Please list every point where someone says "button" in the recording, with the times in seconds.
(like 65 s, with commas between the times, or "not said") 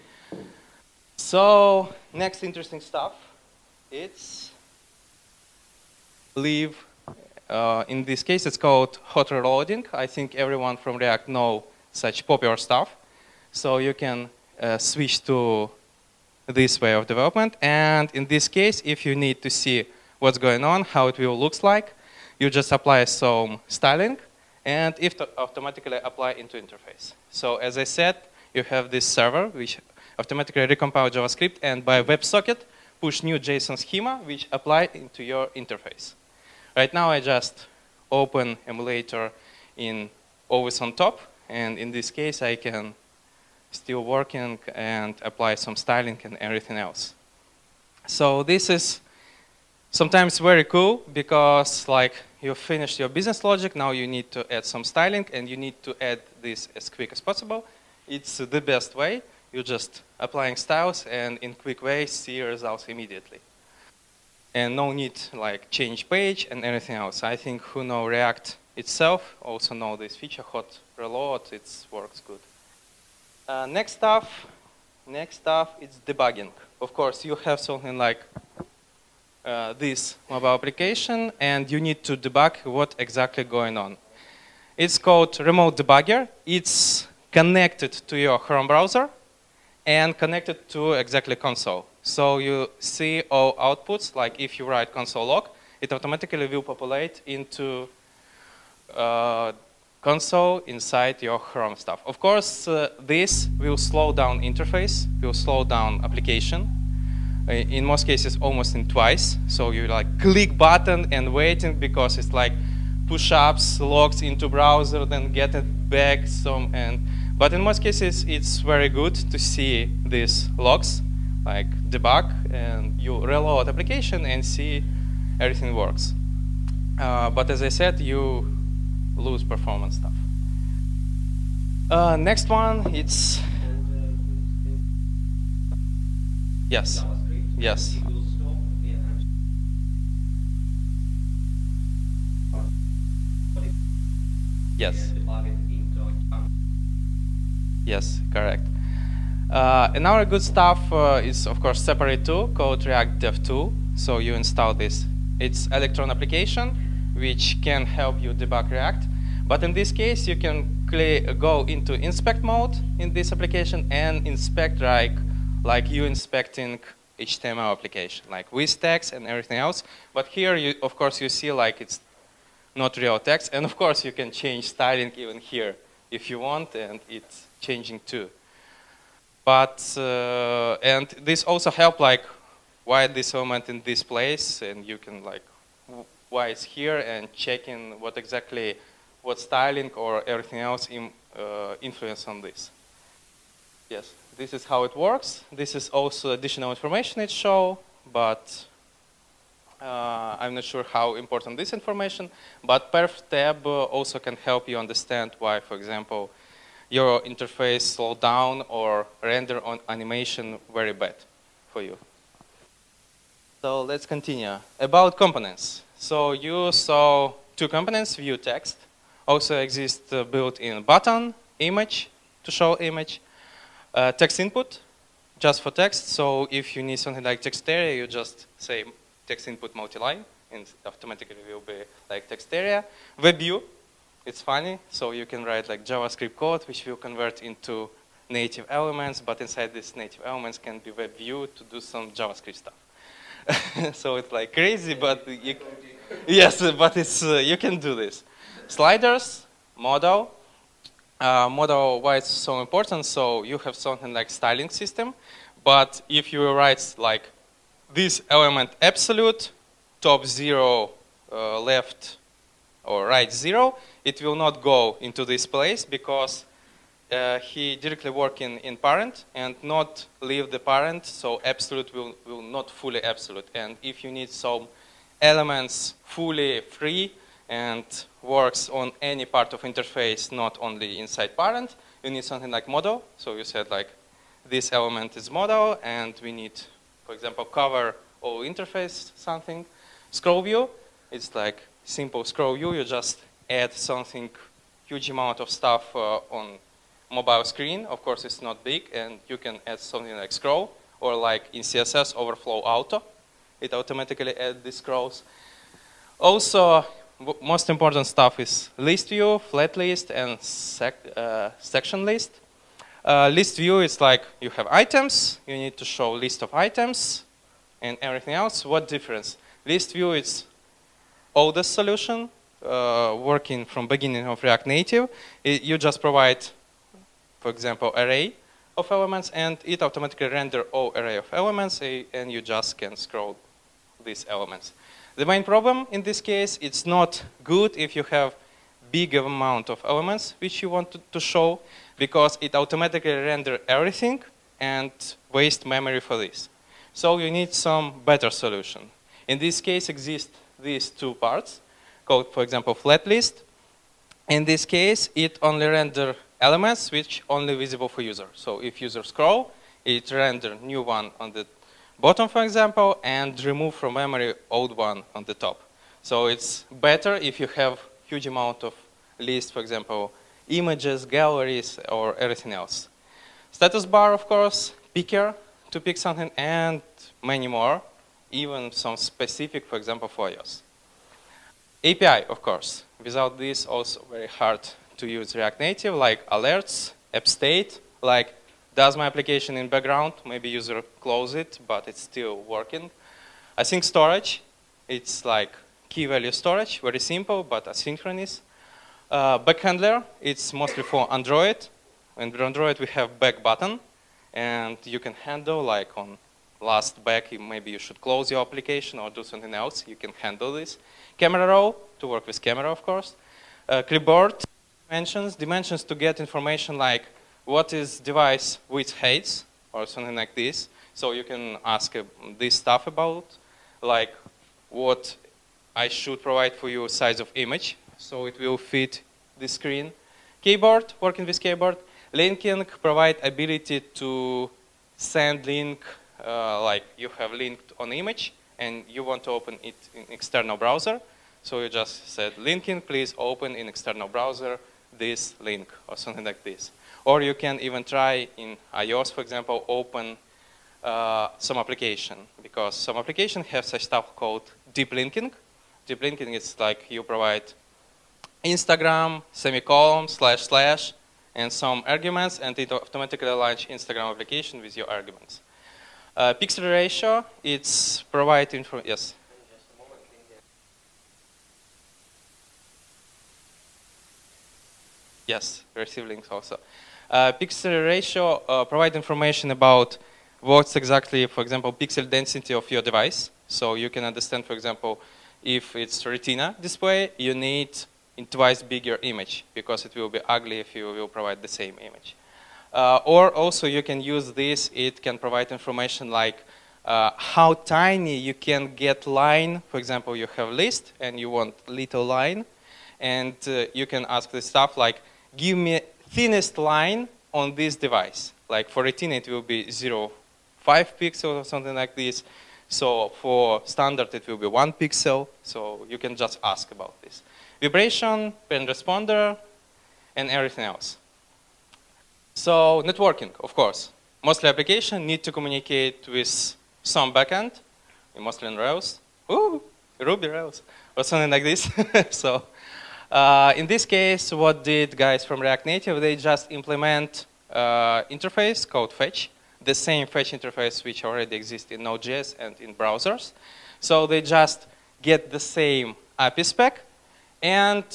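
110 s, 220 s, 403 s.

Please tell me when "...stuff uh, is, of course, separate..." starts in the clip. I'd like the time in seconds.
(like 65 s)
150 s.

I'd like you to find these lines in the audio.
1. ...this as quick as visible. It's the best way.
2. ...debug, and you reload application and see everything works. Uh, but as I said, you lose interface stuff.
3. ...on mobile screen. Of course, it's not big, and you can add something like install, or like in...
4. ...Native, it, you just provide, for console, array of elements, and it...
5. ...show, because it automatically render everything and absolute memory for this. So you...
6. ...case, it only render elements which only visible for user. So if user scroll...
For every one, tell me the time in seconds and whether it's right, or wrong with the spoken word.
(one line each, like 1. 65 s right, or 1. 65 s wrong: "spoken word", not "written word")
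1. 56 s wrong: "possible", not "visible"
2. 121 s wrong: "performance", not "interface"
3. 296 s wrong: "scroll", not "install"
4. 324 s wrong: "example", not "console"
5. 341 s wrong: "waste", not "absolute"
6. 354 s right.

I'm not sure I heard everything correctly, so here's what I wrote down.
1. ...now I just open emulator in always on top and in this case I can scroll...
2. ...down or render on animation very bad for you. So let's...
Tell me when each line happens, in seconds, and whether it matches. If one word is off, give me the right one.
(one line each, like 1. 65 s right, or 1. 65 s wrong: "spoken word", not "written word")
1. 36 s wrong: "still", not "scroll"
2. 208 s right.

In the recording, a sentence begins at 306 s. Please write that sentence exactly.
Also, most important stuff is list view, flat list, and sec uh, section list.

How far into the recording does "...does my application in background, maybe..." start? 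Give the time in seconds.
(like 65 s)
388 s.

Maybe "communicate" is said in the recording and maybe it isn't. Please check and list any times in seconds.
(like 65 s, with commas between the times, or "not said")
525 s.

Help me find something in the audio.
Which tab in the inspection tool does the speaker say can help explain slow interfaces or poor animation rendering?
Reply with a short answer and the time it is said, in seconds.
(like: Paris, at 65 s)
perf tab, at 202 s.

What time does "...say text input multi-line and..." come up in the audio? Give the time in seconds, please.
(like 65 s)
228 s.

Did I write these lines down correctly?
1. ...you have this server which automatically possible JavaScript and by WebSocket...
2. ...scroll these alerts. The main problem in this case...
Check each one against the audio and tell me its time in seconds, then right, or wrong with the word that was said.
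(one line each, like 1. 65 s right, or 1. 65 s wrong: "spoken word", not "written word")
1. 28 s wrong: "recompile", not "possible"
2. 332 s wrong: "elements", not "alerts".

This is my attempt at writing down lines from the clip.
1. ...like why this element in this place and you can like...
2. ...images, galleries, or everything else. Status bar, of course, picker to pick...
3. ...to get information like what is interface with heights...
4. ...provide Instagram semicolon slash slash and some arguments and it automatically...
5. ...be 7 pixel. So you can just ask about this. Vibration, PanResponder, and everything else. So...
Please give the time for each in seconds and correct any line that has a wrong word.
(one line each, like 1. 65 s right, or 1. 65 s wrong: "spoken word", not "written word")
1. 181 s right
2. 370 s right
3. 415 s wrong: "device", not "interface"
4. 457 s right
5. 514 s wrong: "1", not "7".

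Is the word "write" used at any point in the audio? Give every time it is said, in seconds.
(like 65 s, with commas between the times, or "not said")
94 s, 235 s, 256 s.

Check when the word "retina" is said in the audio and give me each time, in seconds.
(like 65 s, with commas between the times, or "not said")
486 s, 508 s.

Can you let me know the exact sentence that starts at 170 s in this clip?
But here, you, of course, you see like it's not real text.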